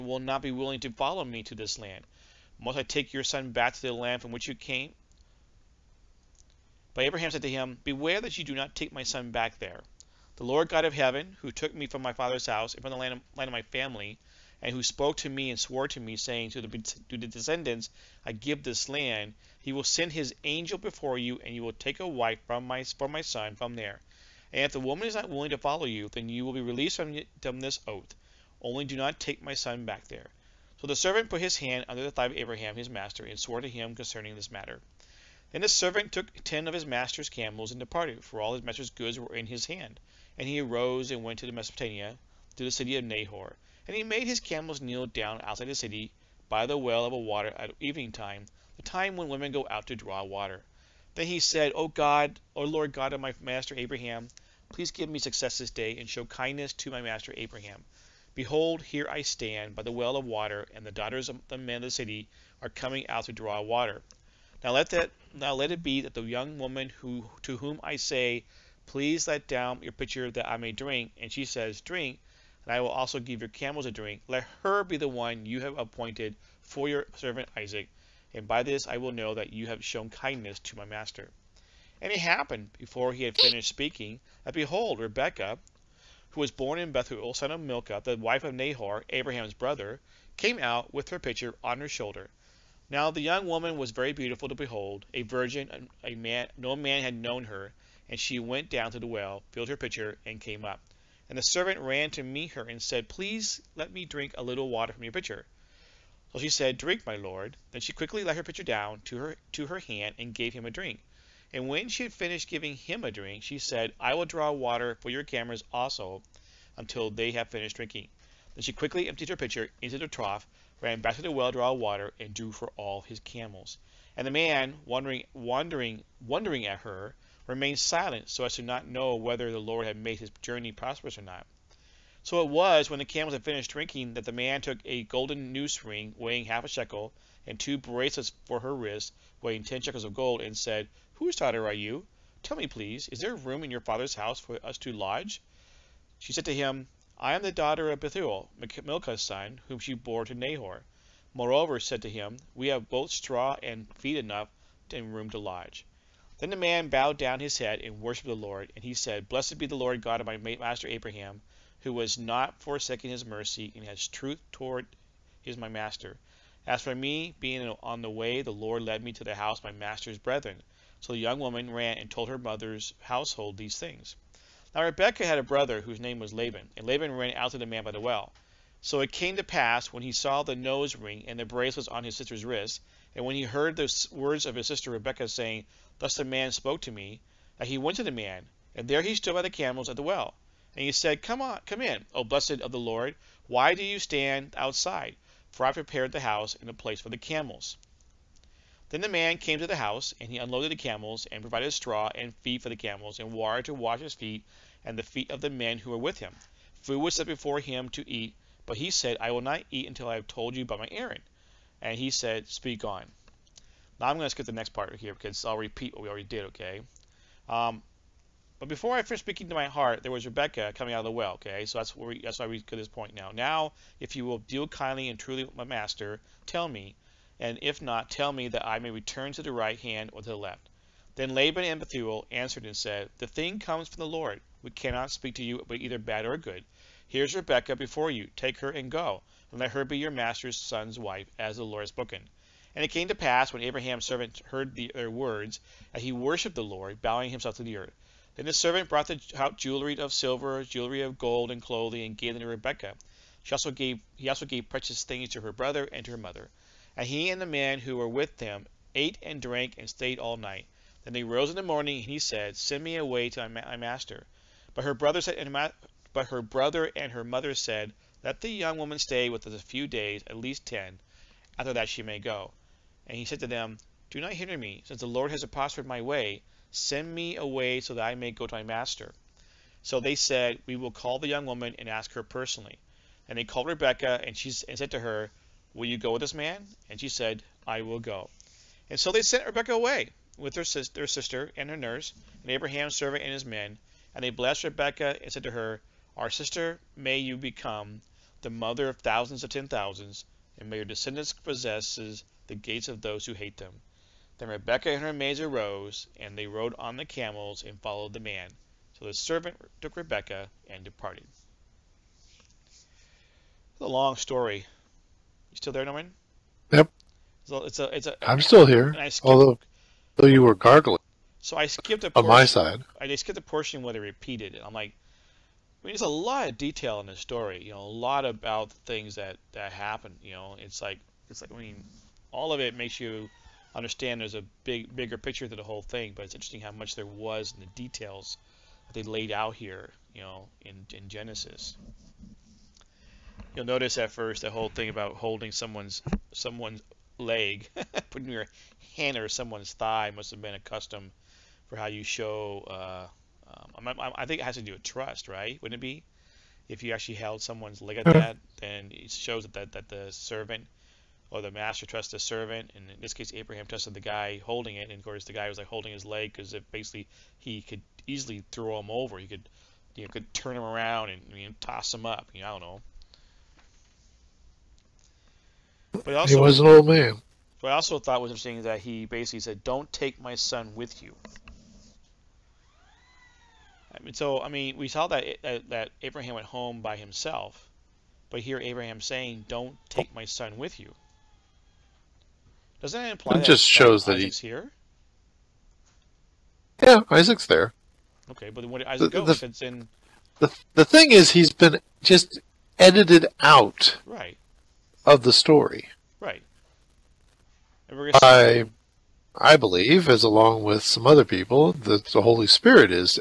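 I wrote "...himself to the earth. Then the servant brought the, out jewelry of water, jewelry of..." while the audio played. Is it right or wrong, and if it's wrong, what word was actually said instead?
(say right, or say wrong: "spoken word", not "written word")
wrong: "silver", not "water".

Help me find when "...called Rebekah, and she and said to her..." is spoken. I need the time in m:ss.
4:43.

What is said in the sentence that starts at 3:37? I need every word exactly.
Um, but before I first speaking to my heart, there was Rebecca coming out of the well, okay?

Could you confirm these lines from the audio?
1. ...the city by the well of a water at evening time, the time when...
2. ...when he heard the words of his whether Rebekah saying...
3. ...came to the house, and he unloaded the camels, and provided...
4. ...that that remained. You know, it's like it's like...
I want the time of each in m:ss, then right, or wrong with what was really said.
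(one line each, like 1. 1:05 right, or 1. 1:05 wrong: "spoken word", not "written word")
1. 0:45 right
2. 3:03 wrong: "sister", not "whether"
3. 3:19 right
4. 5:29 wrong: "happened", not "remained".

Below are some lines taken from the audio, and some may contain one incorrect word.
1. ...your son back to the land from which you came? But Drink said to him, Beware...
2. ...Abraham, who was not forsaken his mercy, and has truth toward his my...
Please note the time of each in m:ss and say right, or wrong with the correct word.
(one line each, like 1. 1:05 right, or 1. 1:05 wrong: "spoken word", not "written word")
1. 0:03 wrong: "Abraham", not "Drink"
2. 2:40 right.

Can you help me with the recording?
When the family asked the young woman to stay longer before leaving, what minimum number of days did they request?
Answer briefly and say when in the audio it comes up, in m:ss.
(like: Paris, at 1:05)
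10, at 4:30.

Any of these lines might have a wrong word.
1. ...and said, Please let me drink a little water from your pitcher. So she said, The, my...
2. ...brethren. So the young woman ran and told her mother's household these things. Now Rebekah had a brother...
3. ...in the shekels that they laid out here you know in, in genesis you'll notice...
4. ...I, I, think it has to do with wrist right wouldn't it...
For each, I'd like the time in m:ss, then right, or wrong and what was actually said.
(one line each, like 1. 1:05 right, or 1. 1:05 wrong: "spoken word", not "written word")
1. 1:42 wrong: "Drink", not "The"
2. 2:50 right
3. 5:37 wrong: "details", not "shekels"
4. 5:53 wrong: "trust", not "wrist".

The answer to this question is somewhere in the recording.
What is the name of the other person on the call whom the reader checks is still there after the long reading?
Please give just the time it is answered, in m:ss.
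5:15.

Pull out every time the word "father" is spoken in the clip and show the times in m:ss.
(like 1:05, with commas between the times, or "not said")
0:12, 2:23.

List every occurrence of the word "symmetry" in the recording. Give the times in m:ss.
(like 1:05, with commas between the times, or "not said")
not said.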